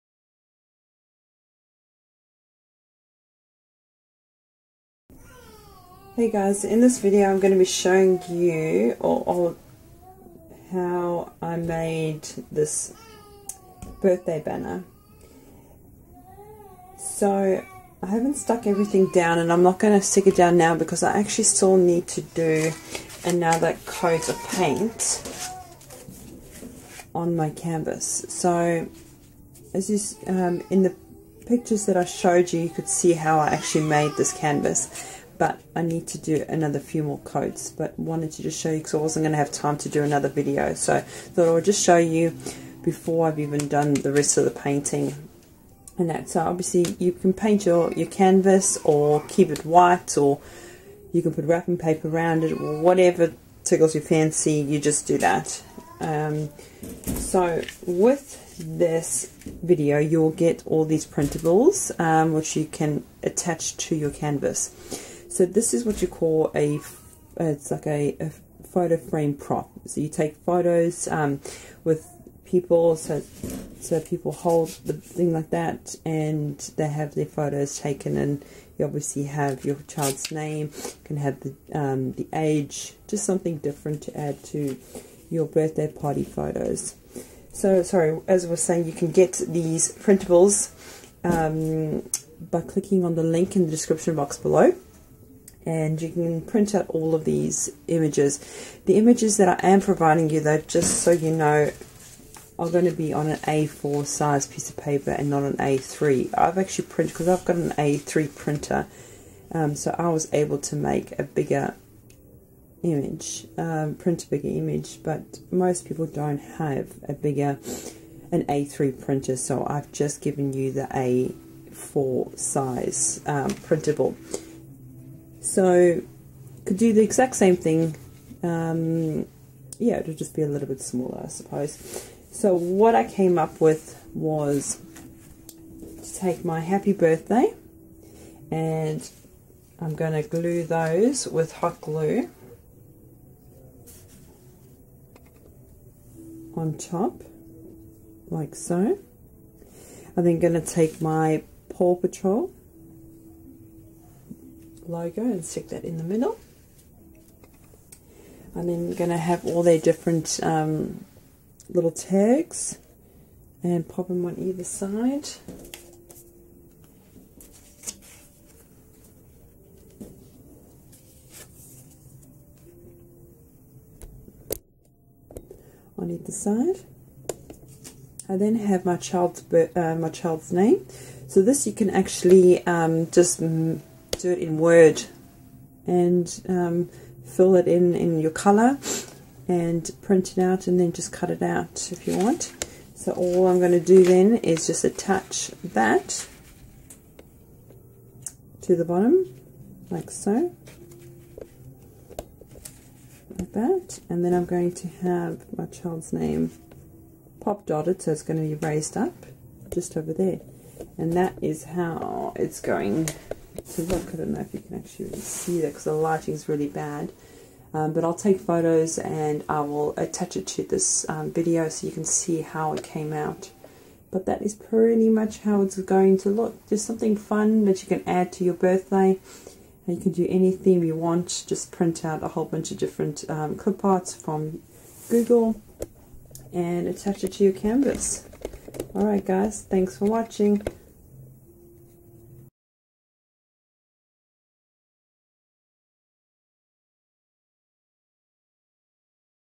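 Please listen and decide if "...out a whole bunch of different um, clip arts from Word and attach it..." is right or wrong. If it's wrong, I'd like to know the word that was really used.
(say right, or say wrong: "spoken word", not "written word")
wrong: "Google", not "Word".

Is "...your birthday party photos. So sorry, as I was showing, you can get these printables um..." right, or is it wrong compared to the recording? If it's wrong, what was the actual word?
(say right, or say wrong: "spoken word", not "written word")
wrong: "saying", not "showing".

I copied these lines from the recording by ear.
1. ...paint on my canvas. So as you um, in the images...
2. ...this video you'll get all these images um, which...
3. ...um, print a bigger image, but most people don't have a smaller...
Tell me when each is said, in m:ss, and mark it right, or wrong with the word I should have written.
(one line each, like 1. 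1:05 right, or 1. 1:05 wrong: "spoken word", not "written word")
1. 0:24 wrong: "pictures", not "images"
2. 0:58 wrong: "printables", not "images"
3. 1:53 wrong: "bigger", not "smaller".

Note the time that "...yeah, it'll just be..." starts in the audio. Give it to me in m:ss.
2:09.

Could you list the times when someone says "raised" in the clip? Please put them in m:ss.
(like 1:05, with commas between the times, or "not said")
3:28.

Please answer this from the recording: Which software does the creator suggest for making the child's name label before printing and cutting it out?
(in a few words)
Word.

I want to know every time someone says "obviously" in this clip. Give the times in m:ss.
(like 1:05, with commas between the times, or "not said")
0:46, 1:18.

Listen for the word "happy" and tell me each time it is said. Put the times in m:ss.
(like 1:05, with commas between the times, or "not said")
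2:16.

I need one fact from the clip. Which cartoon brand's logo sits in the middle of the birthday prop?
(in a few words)
Paw Patrol.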